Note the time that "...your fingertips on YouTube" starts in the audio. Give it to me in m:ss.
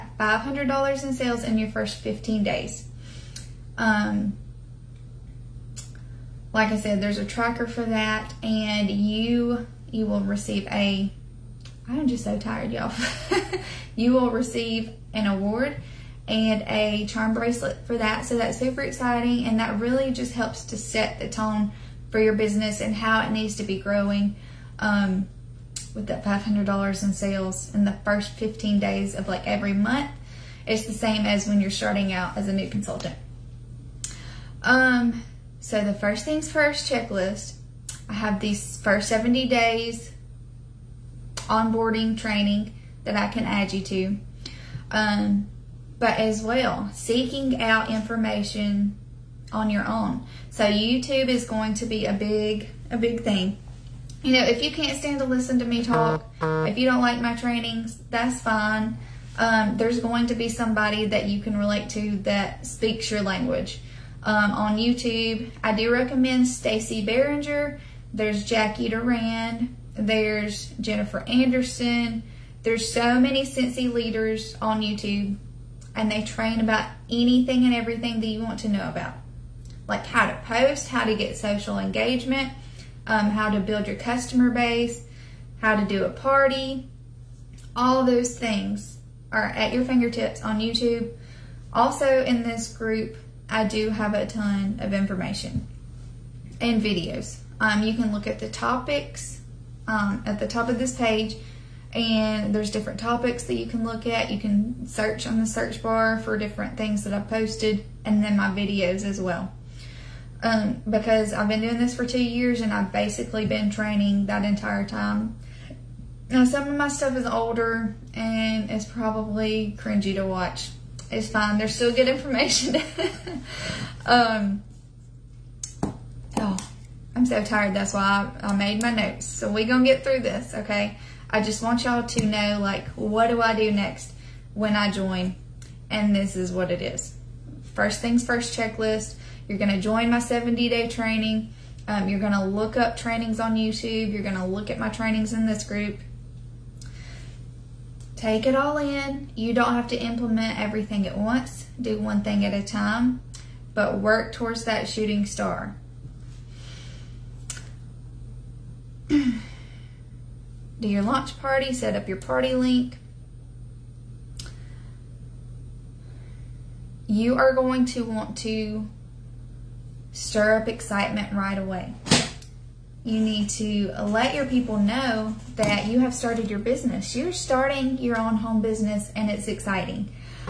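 1:29.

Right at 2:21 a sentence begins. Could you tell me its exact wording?
Um, you're going to look up trainings on YouTube.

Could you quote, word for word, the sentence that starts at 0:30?
It's the same as when you're starting out as a new consultant.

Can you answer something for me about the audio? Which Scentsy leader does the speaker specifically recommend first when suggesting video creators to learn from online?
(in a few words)
Stacy Behringer.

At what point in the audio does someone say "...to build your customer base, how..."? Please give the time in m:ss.
1:23.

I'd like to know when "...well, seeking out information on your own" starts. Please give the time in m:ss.
0:46.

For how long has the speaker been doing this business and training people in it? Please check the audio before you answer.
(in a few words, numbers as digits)
two years.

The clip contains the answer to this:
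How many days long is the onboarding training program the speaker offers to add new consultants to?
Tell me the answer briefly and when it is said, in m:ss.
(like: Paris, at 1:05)
70, at 0:39.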